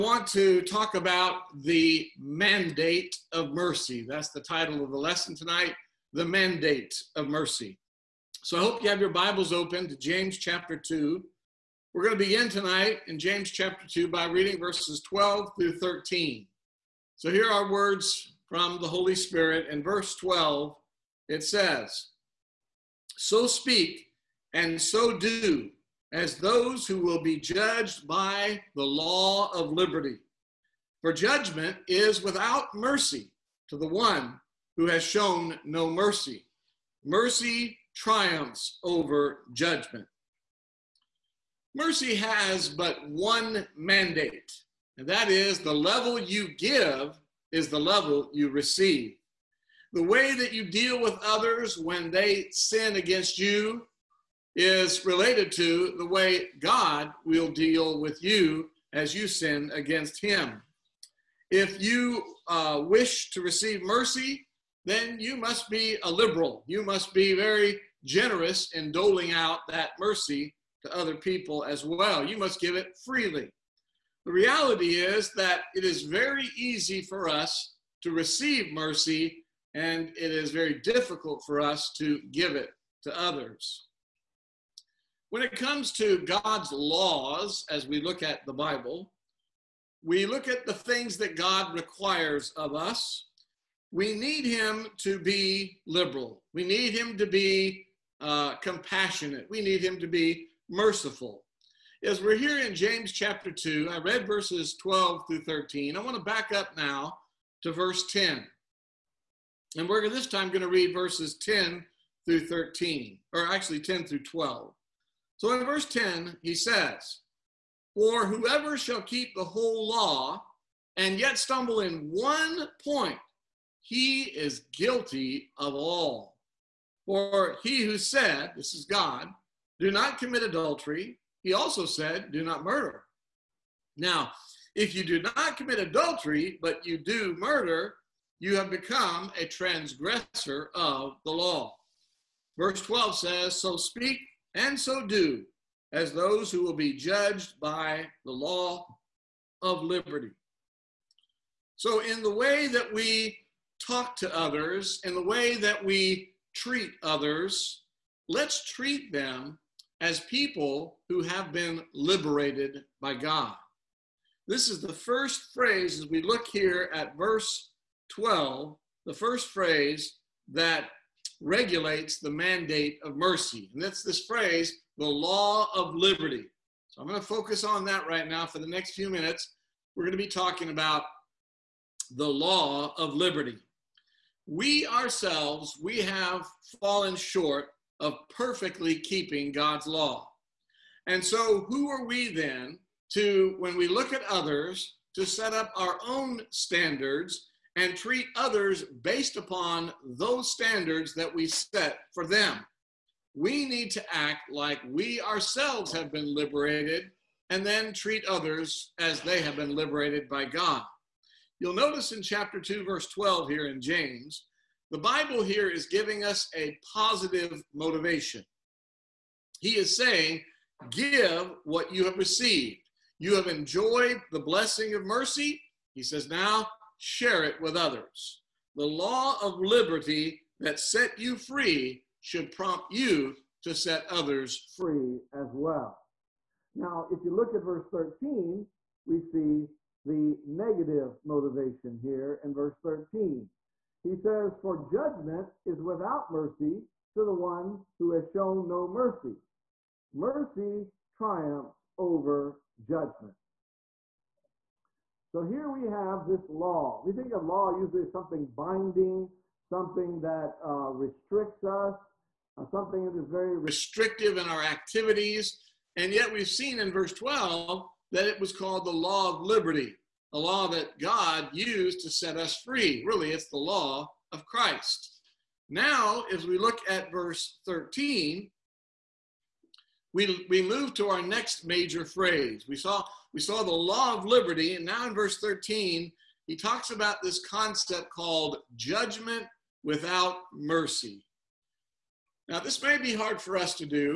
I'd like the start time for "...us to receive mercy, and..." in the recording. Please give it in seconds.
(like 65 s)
77 s.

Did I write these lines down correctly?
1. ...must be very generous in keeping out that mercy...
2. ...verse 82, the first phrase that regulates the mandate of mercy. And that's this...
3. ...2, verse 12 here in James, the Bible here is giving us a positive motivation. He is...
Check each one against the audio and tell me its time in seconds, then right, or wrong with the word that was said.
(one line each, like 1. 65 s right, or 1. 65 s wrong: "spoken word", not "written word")
1. 66 s wrong: "doling", not "keeping"
2. 167 s wrong: "12", not "82"
3. 212 s right.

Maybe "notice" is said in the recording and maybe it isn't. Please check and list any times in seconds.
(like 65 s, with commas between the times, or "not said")
211 s.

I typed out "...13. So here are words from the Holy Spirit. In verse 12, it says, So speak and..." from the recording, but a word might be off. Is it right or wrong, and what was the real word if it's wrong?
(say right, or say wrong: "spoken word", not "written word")
right.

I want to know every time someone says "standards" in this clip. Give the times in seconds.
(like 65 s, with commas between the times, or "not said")
196 s, 200 s.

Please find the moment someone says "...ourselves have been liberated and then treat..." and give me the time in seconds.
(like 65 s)
205 s.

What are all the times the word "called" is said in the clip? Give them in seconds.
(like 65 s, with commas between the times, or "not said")
268 s, 288 s.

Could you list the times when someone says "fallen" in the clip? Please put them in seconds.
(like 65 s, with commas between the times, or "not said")
186 s.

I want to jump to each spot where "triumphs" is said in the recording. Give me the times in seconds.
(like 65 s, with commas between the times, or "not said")
37 s, 251 s.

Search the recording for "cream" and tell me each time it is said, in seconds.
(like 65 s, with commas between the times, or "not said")
not said.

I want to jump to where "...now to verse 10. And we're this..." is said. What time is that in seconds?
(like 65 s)
106 s.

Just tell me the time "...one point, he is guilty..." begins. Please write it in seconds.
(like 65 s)
122 s.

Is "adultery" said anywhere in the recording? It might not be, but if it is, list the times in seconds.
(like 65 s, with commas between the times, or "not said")
130 s, 135 s.